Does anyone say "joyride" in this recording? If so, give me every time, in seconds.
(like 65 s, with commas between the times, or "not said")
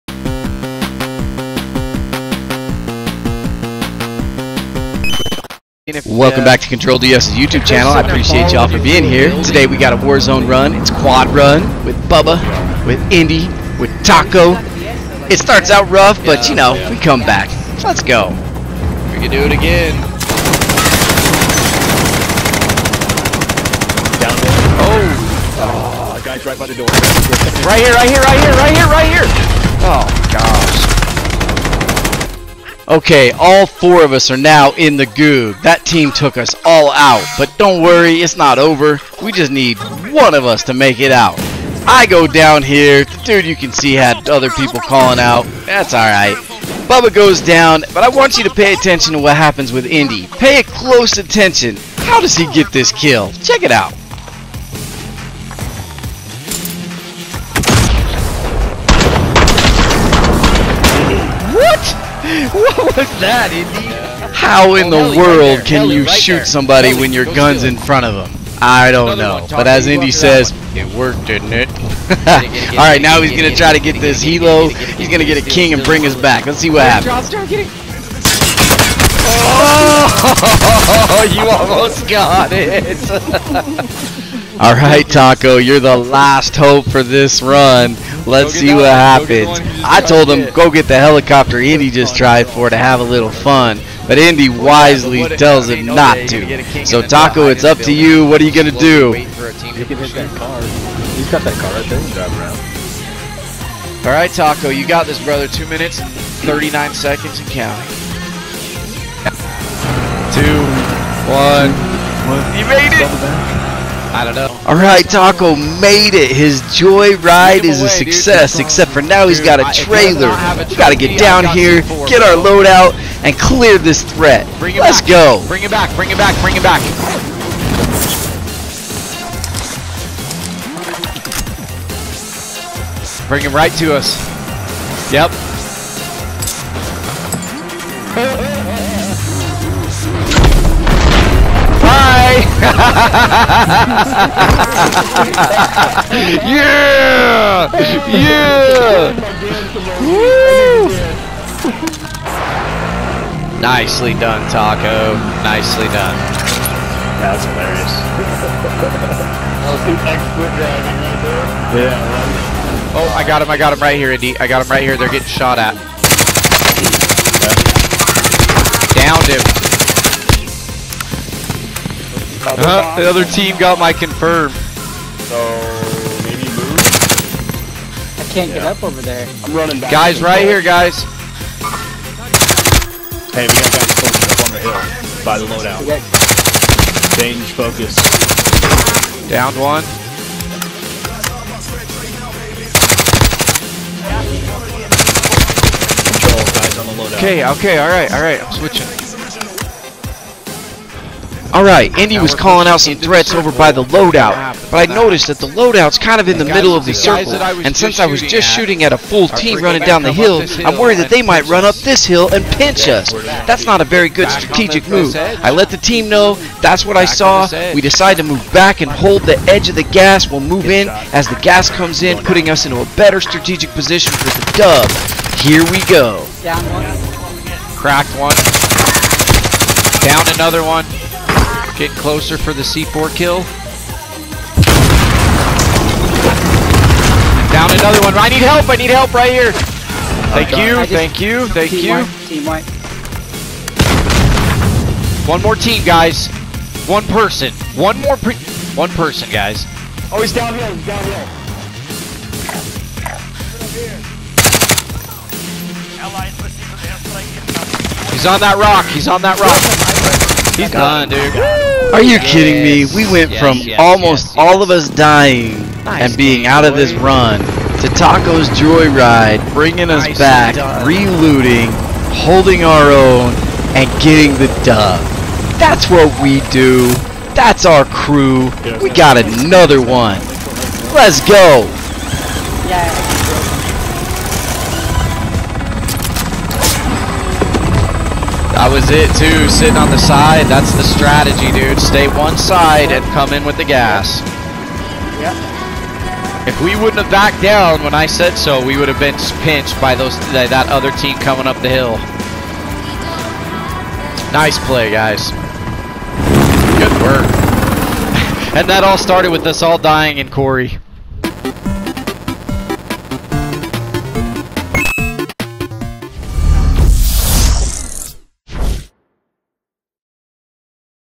116 s, 268 s.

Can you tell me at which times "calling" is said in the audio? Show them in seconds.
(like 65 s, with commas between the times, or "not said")
44 s, 202 s.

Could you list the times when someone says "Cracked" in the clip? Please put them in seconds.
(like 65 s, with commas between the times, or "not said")
227 s.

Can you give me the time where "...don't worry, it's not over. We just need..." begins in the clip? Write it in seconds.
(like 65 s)
37 s.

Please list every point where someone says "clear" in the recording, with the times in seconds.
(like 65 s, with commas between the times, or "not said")
123 s.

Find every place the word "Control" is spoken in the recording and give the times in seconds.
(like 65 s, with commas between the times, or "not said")
6 s, 196 s.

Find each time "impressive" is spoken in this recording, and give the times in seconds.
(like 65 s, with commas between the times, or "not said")
not said.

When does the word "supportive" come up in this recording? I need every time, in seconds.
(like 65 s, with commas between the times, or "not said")
not said.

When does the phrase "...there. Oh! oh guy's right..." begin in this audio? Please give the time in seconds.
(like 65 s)
24 s.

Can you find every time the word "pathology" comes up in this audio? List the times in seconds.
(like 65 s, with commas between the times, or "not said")
not said.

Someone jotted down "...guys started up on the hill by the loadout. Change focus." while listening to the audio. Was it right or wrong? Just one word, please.
wrong.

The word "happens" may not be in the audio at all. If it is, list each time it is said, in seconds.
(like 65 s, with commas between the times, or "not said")
49 s, 76 s, 88 s.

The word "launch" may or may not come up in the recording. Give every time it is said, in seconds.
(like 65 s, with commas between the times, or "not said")
not said.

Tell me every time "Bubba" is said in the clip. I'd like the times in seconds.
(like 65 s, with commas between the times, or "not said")
12 s, 46 s.